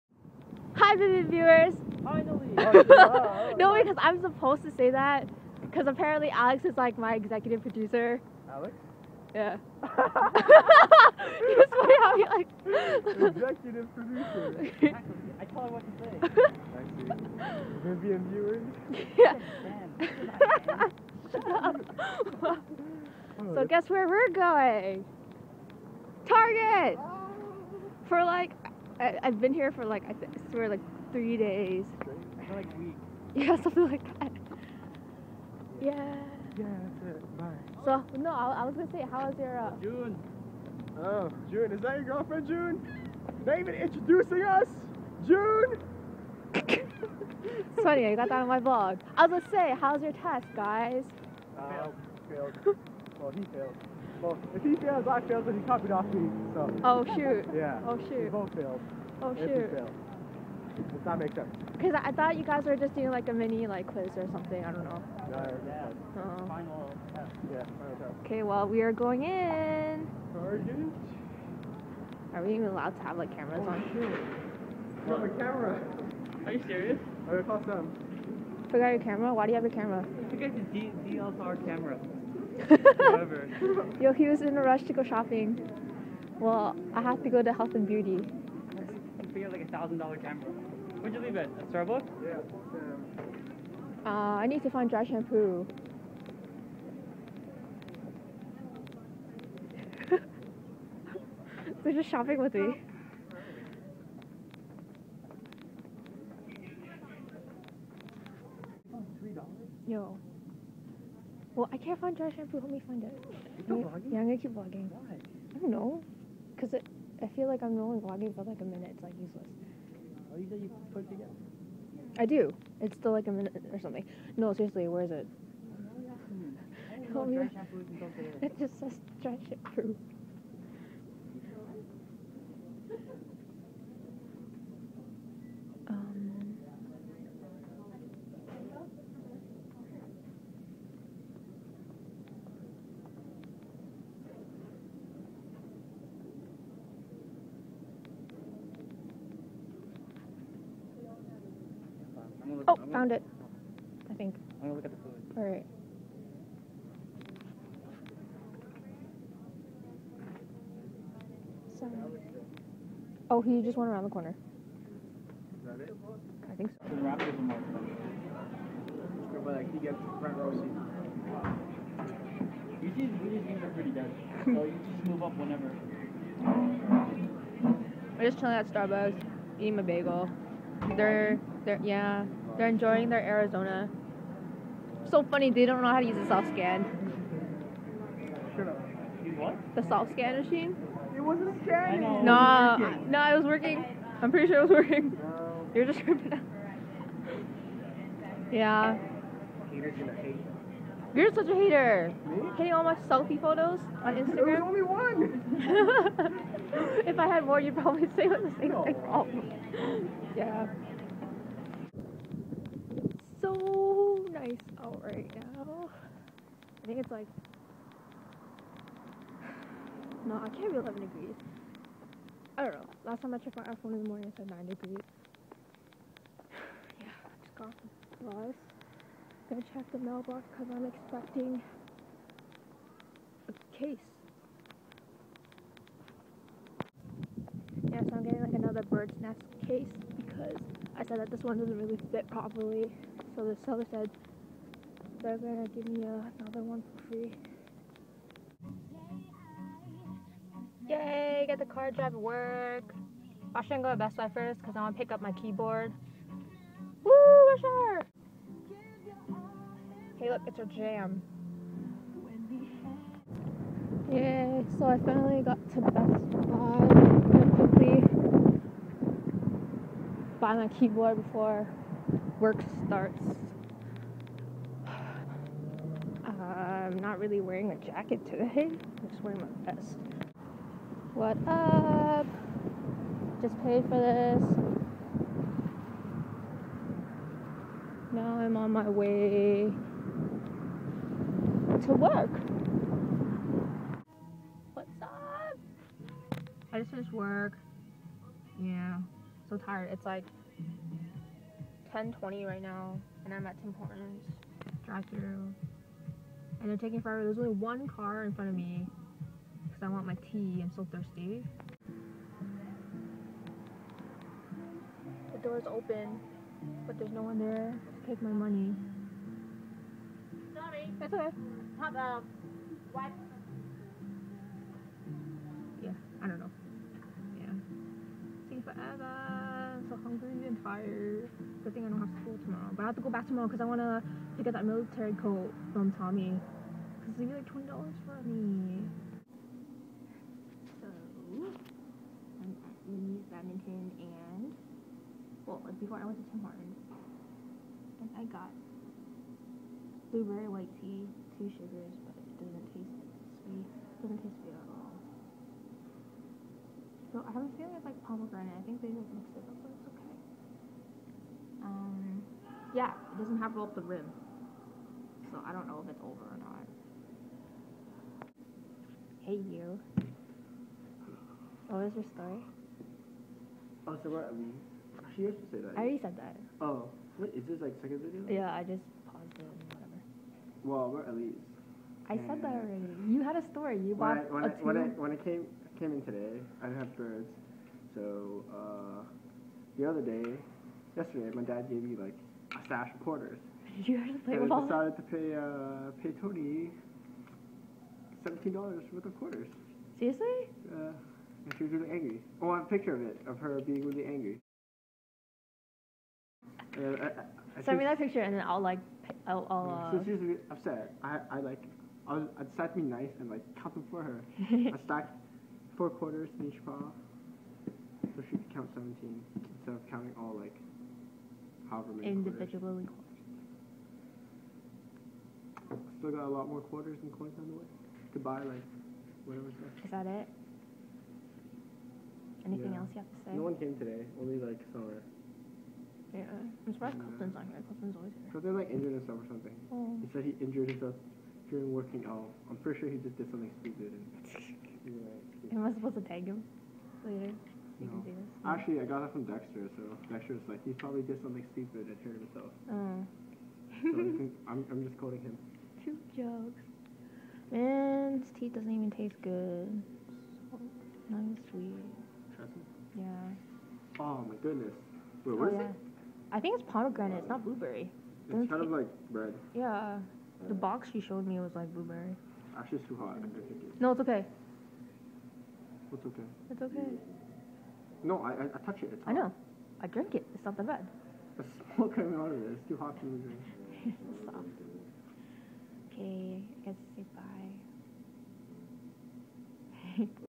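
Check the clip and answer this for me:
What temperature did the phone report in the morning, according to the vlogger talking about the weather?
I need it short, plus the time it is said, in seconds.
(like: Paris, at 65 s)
9 degrees, at 224 s.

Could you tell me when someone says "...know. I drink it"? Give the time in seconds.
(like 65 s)
479 s.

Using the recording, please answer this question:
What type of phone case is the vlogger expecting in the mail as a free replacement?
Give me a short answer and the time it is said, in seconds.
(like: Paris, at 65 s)
bird's nest case, at 238 s.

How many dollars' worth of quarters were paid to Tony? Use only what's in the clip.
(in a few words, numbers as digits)
17.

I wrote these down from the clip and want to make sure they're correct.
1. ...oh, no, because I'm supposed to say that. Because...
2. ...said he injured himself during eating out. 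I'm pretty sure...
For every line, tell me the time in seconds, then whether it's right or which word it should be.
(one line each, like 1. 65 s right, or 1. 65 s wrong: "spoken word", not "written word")
1. 3 s right
2. 440 s wrong: "working", not "eating".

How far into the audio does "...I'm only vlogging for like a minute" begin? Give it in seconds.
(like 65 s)
117 s.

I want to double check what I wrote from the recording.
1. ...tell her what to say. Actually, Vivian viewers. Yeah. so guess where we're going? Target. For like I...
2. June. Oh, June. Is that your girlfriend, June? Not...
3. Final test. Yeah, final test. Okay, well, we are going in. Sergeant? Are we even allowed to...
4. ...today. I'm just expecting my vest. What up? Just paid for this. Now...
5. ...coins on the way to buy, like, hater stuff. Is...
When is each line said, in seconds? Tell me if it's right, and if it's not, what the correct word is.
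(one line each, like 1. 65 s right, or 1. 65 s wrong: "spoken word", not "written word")
1. 15 s right
2. 39 s right
3. 66 s right
4. 278 s wrong: "wearing", not "expecting"
5. 427 s wrong: "whatever", not "hater".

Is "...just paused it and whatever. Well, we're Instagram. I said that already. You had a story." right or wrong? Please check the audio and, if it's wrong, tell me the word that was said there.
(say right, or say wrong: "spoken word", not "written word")
wrong: "Elise", not "Instagram".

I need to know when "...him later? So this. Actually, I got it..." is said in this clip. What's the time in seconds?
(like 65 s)
446 s.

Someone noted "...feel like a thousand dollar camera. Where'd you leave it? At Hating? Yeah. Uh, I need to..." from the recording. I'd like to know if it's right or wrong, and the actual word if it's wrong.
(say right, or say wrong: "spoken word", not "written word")
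wrong: "Starbucks", not "Hating".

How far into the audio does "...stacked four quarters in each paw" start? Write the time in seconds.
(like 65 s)
414 s.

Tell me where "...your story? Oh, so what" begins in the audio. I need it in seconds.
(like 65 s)
371 s.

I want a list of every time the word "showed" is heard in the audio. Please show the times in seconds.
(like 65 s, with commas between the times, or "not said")
471 s.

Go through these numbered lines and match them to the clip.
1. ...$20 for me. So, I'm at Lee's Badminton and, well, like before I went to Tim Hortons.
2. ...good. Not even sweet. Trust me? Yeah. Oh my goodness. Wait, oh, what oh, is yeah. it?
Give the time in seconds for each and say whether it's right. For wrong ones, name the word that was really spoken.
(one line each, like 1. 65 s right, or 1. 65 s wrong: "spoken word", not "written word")
1. 337 s right
2. 459 s right.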